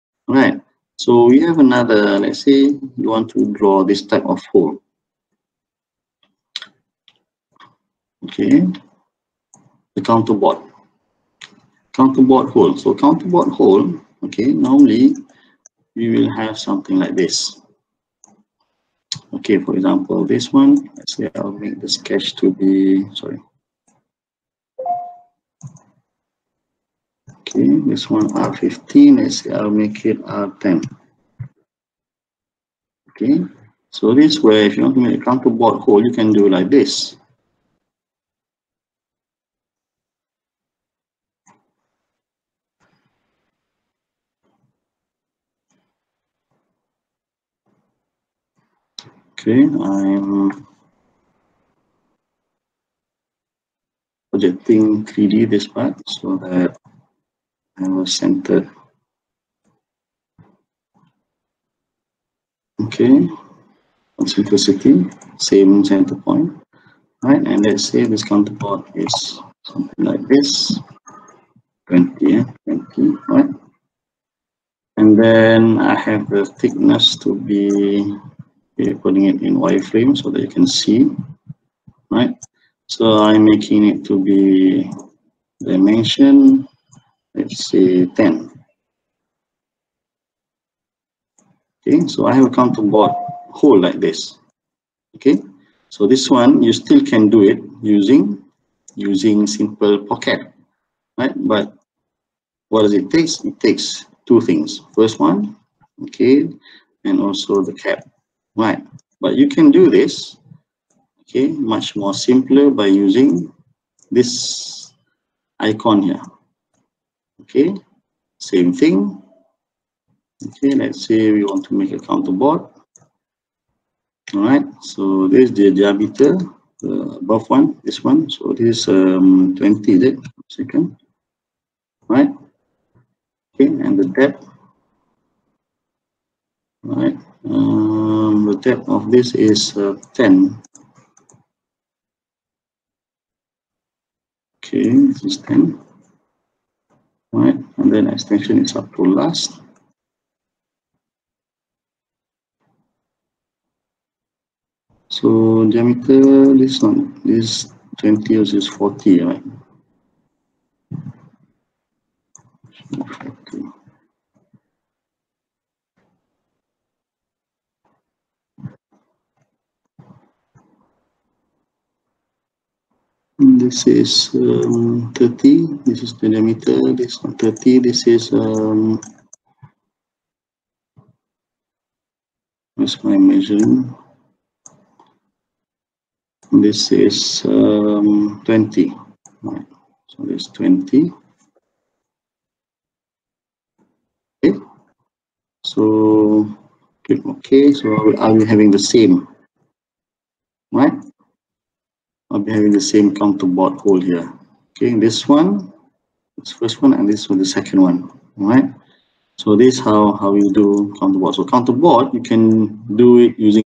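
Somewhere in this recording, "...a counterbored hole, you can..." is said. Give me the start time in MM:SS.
00:35.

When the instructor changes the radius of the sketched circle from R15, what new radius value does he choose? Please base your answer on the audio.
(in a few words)
R10.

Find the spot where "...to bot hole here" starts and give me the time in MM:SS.
03:23.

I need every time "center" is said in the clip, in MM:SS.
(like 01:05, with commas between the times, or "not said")
00:58, 01:05.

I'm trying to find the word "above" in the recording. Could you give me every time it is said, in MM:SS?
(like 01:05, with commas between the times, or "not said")
02:07.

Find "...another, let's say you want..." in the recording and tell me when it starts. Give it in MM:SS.
00:01.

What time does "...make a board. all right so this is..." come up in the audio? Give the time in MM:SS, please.
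02:01.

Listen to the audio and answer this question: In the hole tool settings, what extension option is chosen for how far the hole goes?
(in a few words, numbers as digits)
Up to last.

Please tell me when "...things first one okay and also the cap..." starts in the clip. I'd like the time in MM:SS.
01:44.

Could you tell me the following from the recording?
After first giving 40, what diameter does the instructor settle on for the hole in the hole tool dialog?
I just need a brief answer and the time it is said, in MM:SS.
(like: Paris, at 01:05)
30, at 02:55.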